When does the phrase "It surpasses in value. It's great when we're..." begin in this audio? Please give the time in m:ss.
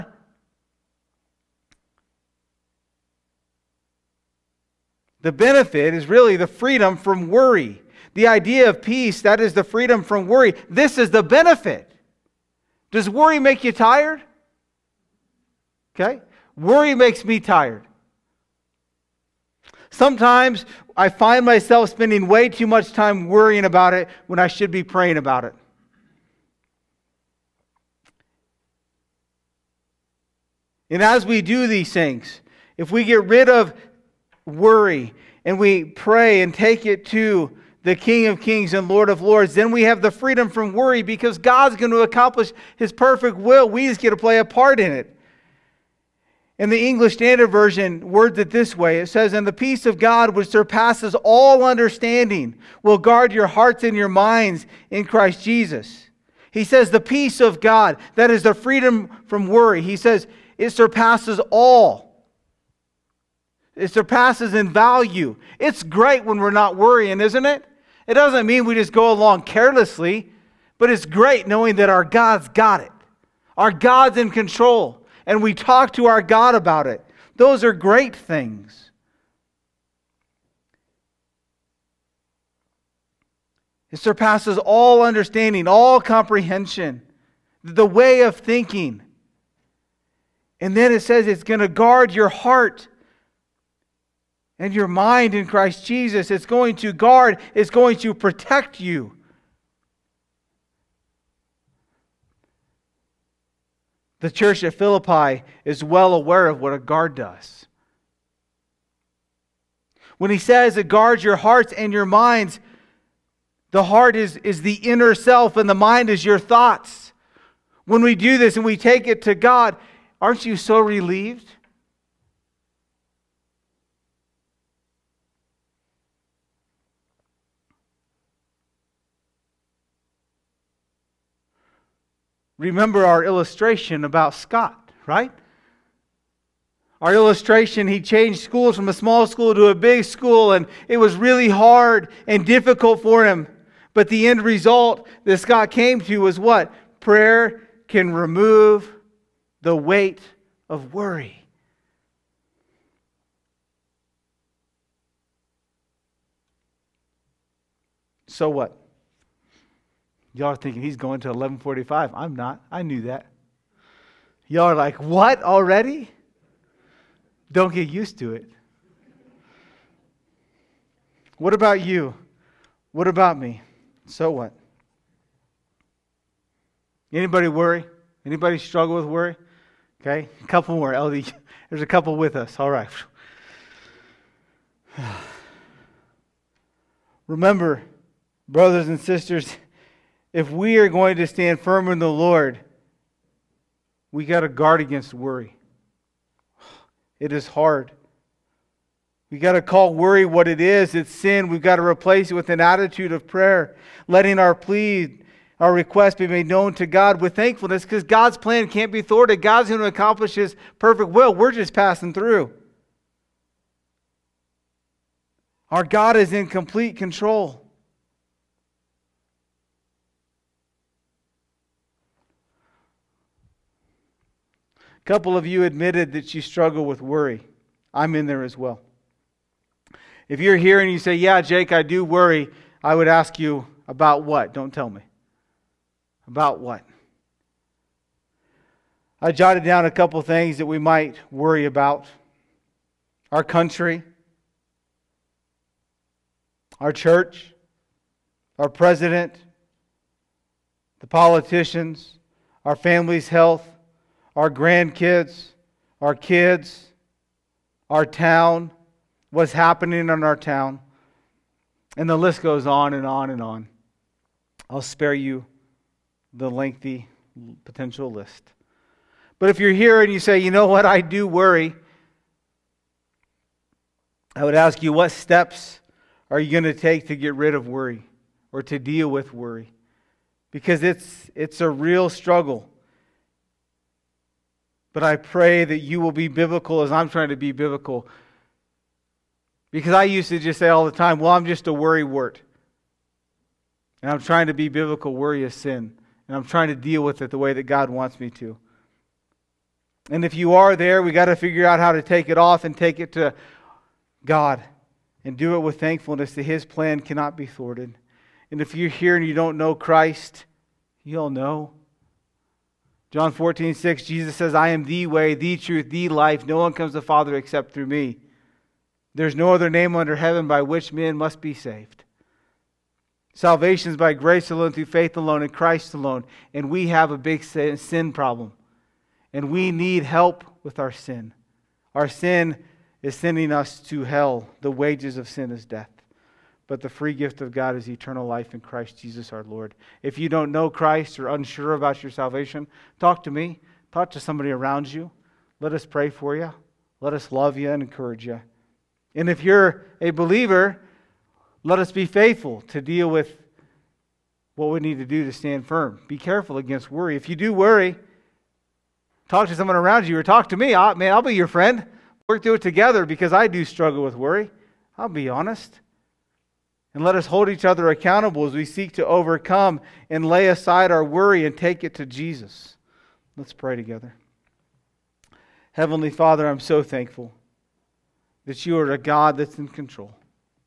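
1:03.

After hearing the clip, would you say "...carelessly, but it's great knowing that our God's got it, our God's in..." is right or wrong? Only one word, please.
right.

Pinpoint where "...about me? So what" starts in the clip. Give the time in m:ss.
2:53.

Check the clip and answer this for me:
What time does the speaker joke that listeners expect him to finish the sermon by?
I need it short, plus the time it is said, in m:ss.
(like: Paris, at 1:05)
11:45, at 2:41.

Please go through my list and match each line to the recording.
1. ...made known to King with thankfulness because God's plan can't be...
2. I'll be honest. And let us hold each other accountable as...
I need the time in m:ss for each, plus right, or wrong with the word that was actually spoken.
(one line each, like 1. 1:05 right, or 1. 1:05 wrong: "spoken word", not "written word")
1. 3:26 wrong: "God", not "King"
2. 6:04 right.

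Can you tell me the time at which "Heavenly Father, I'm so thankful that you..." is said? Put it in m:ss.
6:15.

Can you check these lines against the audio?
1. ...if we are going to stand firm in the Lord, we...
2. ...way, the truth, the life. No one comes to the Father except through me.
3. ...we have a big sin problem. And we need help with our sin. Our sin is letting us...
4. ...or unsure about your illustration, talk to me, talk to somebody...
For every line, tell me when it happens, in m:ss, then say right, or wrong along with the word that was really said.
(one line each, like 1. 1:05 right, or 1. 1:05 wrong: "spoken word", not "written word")
1. 3:10 right
2. 5:15 right
3. 5:26 wrong: "sending", not "letting"
4. 5:41 wrong: "salvation", not "illustration".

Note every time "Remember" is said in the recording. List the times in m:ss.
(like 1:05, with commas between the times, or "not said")
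2:12, 3:07.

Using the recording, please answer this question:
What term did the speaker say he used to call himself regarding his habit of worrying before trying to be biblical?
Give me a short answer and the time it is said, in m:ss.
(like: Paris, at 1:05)
worry wart, at 4:51.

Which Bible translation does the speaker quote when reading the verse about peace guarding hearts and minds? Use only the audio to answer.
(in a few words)
English Standard Version.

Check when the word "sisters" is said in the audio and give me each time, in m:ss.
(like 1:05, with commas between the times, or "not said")
3:08.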